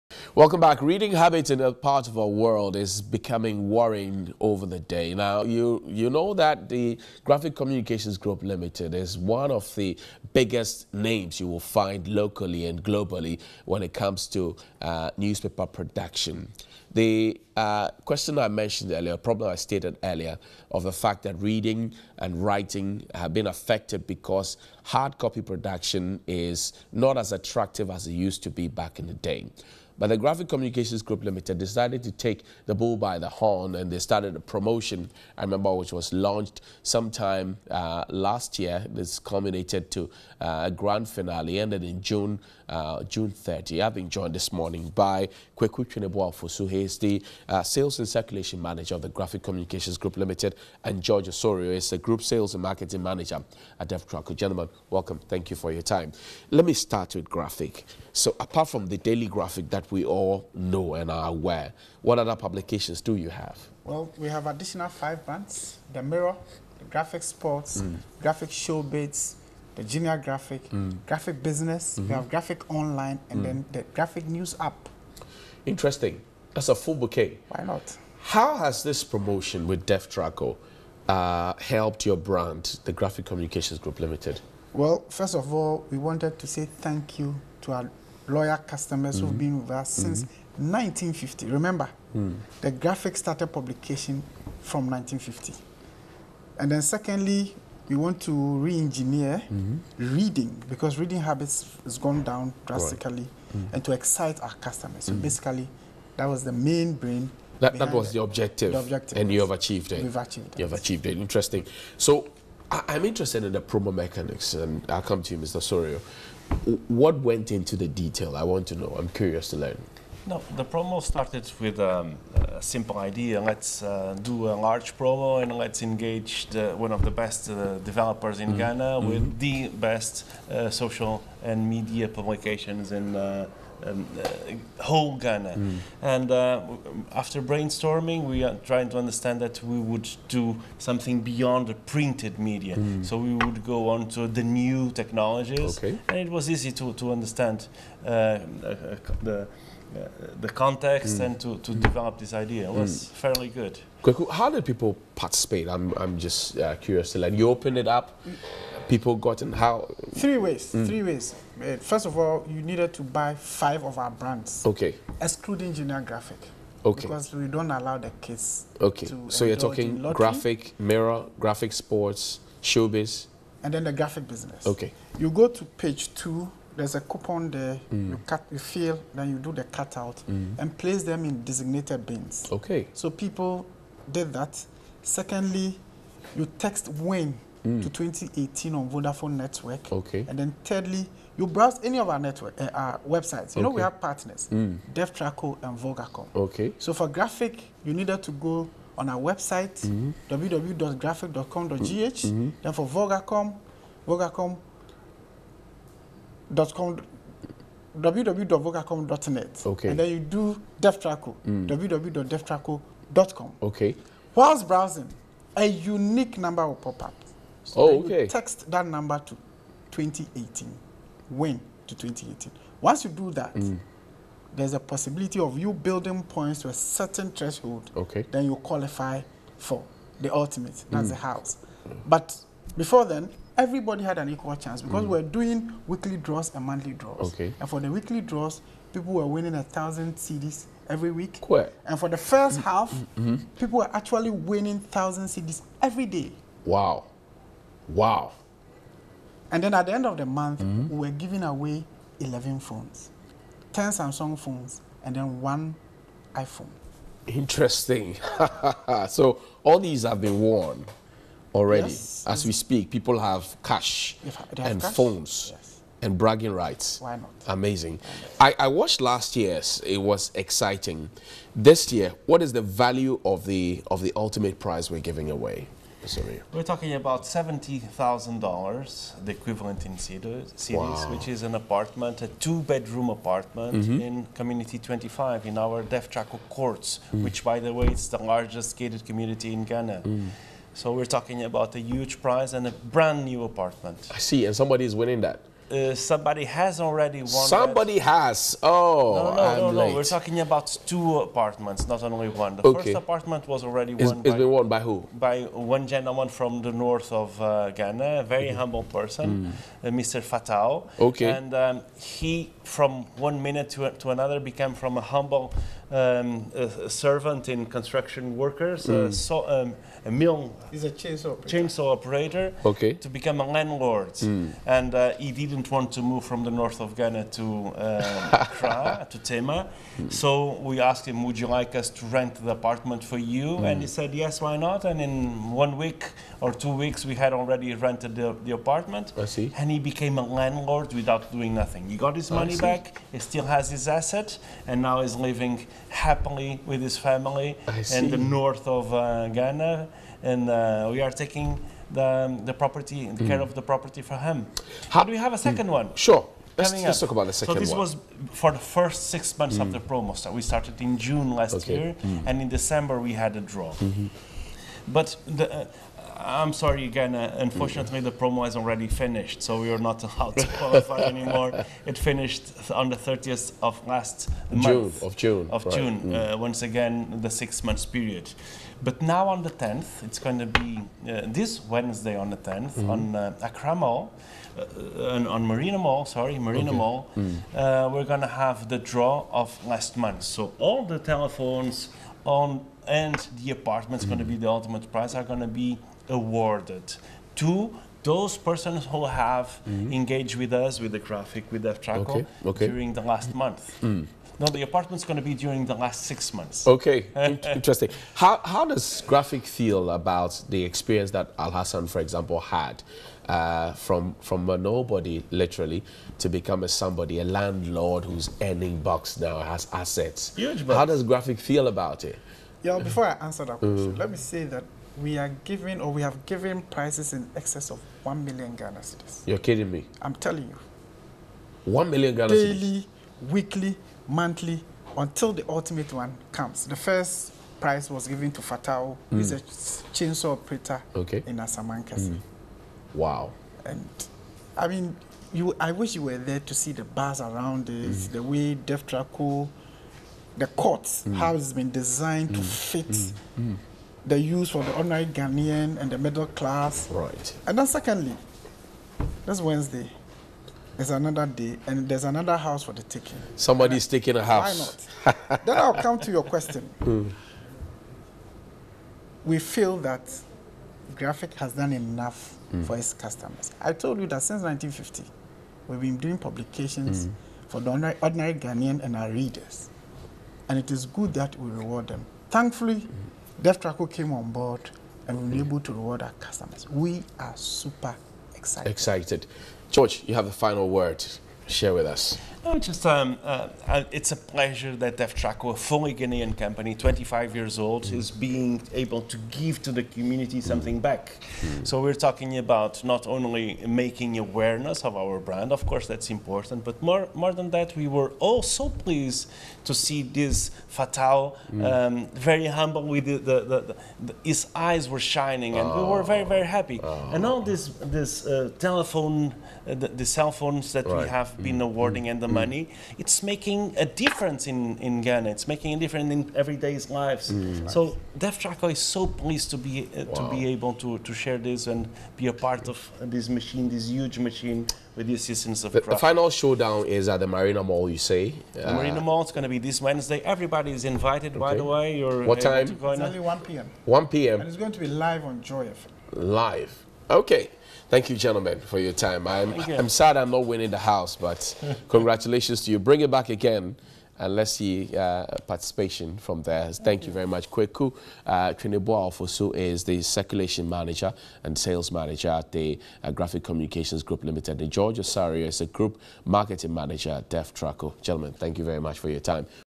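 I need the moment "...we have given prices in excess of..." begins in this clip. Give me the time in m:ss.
7:05.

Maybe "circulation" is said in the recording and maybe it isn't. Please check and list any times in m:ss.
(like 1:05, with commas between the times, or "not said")
0:48, 9:20.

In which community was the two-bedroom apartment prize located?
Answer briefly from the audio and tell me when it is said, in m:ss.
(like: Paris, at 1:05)
Community 25, at 4:44.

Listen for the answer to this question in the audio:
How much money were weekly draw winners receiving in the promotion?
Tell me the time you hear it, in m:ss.
3:59.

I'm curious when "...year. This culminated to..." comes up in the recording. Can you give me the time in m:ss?
0:38.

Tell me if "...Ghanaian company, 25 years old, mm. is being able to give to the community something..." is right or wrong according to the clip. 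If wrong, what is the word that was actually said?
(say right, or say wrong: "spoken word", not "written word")
right.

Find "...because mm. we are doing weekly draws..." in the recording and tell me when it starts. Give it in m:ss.
3:54.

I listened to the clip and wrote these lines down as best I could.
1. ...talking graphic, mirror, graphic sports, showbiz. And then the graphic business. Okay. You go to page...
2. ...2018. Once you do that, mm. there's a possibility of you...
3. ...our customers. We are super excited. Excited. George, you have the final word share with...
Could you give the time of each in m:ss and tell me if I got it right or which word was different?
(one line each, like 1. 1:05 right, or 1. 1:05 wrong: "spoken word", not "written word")
1. 2:49 right
2. 3:41 right
3. 8:06 right.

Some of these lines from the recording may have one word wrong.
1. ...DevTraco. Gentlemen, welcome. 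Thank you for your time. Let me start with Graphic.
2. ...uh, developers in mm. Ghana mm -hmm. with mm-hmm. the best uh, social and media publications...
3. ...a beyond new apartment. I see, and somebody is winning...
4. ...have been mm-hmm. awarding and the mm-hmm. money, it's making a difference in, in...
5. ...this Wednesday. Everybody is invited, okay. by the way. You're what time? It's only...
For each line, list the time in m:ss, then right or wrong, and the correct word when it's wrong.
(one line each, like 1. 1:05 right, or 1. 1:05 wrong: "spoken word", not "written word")
1. 0:53 right
2. 2:07 right
3. 4:52 wrong: "brand", not "beyond"
4. 8:41 right
5. 8:59 right.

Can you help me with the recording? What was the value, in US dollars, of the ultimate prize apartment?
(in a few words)
$70,000.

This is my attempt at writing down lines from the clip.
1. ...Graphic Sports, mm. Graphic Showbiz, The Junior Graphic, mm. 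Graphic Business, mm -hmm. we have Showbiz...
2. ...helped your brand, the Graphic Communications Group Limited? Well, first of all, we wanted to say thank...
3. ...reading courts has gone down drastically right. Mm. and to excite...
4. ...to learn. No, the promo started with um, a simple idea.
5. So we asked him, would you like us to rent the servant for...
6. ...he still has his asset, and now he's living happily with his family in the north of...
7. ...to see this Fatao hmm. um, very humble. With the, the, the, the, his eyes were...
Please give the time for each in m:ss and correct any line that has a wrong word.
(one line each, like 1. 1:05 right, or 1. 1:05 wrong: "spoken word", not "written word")
1. 1:06 wrong: "Graphic", not "Showbiz"
2. 1:21 right
3. 1:40 wrong: "habits", not "courts"
4. 1:59 right
5. 5:30 wrong: "apartment", not "servant"
6. 5:43 right
7. 8:29 right.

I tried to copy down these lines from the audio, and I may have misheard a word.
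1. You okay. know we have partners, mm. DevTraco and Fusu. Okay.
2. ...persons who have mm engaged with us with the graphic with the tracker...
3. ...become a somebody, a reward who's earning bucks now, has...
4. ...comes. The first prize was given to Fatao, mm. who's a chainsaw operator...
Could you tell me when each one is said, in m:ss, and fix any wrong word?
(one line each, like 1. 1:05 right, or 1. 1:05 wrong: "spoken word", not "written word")
1. 3:13 wrong: "Vogacom", not "Fusu"
2. 6:38 right
3. 6:56 wrong: "landlord", not "reward"
4. 7:16 right.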